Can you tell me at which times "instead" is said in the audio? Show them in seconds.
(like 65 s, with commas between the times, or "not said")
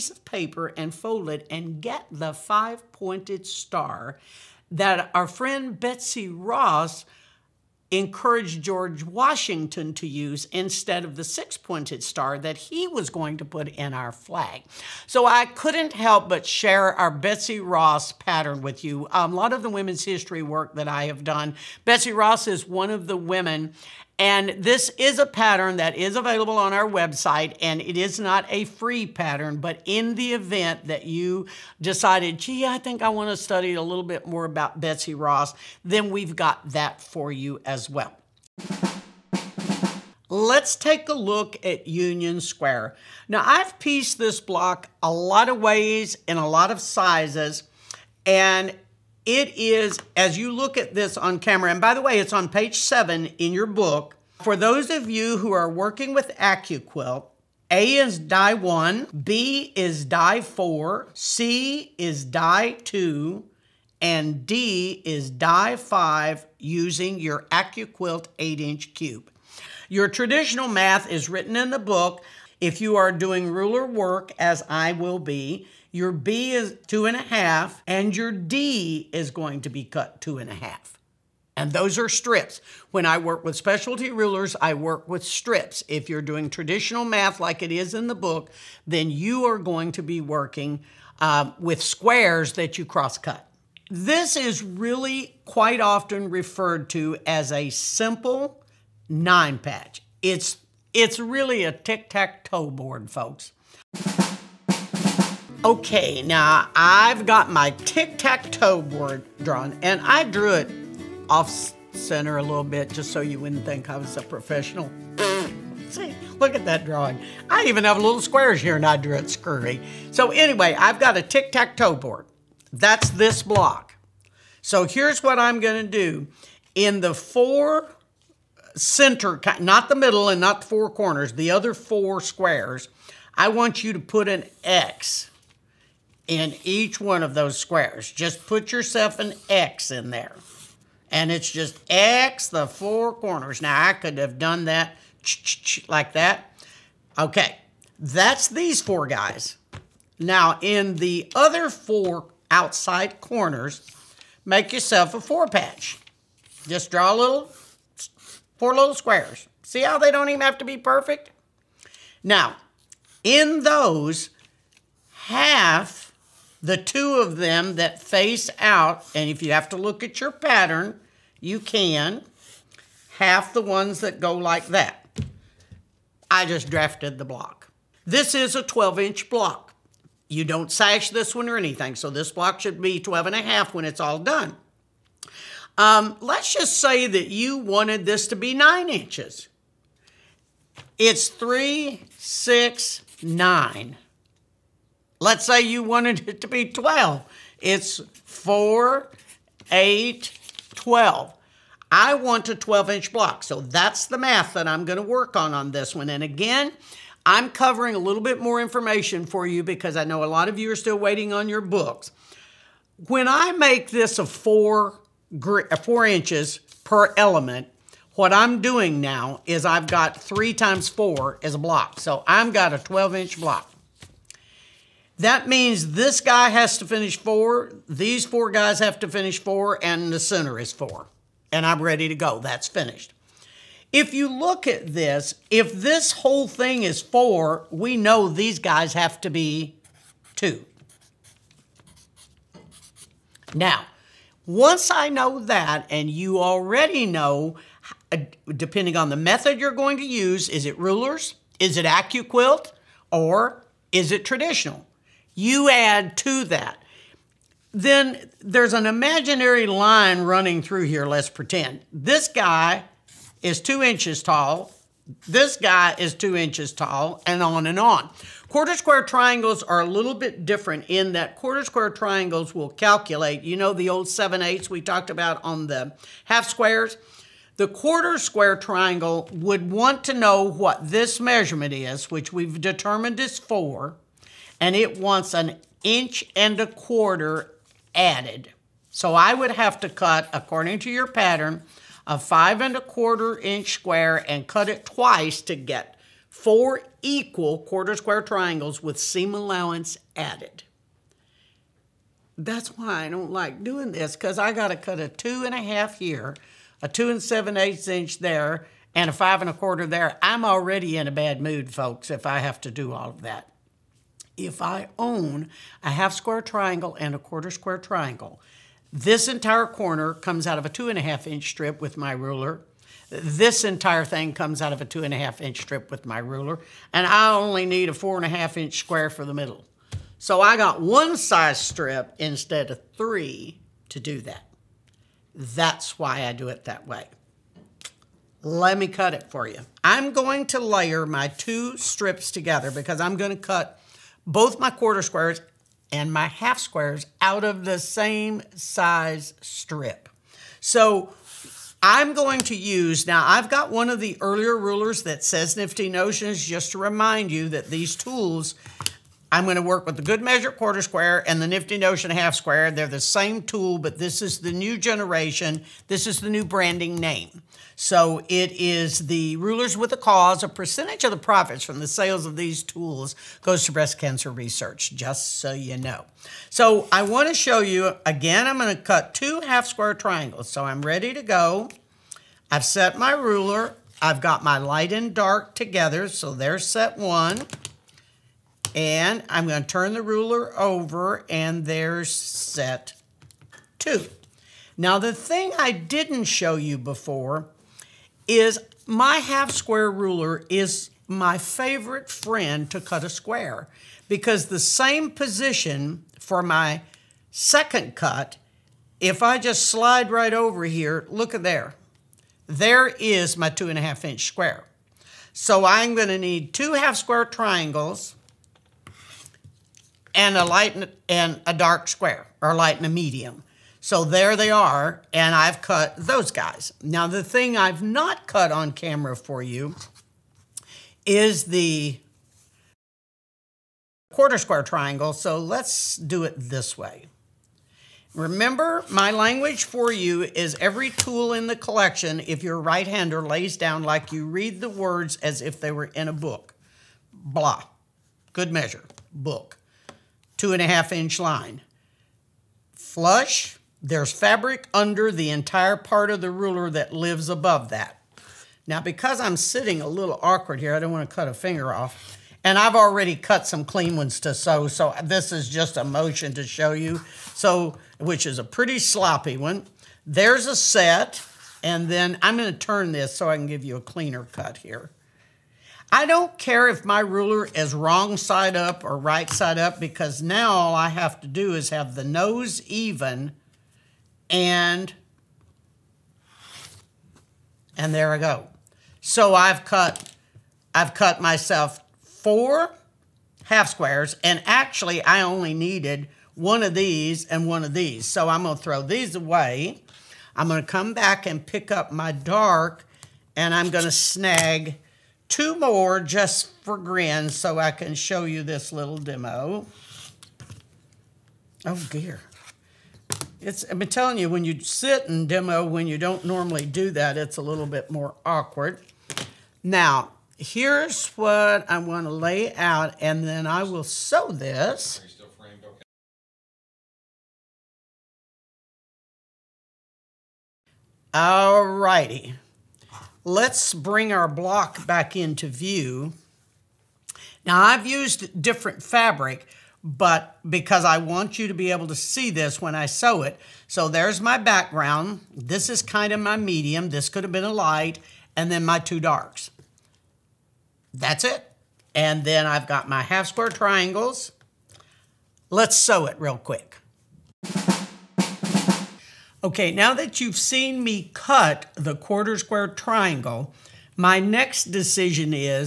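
10 s, 332 s.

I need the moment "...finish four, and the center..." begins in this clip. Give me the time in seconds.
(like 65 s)
229 s.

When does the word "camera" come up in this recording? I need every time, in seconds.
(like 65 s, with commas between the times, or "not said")
51 s, 428 s.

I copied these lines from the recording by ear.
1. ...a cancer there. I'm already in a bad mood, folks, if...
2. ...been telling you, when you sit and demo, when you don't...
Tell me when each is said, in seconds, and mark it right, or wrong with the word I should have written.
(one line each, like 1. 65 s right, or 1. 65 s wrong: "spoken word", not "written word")
1. 309 s wrong: "quarter", not "cancer"
2. 513 s right.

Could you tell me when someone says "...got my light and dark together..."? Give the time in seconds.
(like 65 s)
384 s.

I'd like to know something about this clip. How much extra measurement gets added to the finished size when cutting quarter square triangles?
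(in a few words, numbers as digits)
an inch and a quarter.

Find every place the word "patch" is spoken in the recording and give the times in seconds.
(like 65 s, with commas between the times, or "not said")
99 s, 155 s.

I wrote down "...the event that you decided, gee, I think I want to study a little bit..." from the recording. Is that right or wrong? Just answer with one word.
right.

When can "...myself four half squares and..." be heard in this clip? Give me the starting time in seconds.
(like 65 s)
491 s.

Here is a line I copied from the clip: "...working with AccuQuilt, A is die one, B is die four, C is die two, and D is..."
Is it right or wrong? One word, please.
right.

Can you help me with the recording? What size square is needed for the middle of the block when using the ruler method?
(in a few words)
4 and a half inch.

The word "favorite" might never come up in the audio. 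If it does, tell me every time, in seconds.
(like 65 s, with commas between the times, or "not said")
401 s.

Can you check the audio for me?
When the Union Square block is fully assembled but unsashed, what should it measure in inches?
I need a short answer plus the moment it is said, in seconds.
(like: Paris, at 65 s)
12 and a half, at 182 s.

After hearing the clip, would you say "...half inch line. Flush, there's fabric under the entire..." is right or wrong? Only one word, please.
right.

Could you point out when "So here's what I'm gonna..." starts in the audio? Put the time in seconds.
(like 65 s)
124 s.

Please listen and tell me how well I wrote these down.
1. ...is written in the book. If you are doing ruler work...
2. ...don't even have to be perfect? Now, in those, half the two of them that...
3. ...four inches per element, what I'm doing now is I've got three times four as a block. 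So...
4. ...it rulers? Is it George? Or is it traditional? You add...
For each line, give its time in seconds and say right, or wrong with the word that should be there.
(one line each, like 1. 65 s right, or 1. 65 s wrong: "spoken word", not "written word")
1. 71 s right
2. 160 s right
3. 215 s right
4. 250 s wrong: "AccuQuilt", not "George".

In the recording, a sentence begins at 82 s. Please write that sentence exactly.
When I work with specialty rulers, I work with strips.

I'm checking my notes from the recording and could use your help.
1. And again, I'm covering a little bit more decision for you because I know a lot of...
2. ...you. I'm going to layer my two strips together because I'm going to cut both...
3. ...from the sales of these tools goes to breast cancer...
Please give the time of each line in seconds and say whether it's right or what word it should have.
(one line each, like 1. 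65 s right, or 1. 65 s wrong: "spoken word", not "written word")
1. 206 s wrong: "information", not "decision"
2. 339 s right
3. 371 s right.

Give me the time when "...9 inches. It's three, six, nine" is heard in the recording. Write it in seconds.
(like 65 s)
188 s.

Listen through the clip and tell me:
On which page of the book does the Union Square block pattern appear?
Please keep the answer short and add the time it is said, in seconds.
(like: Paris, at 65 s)
7, at 52 s.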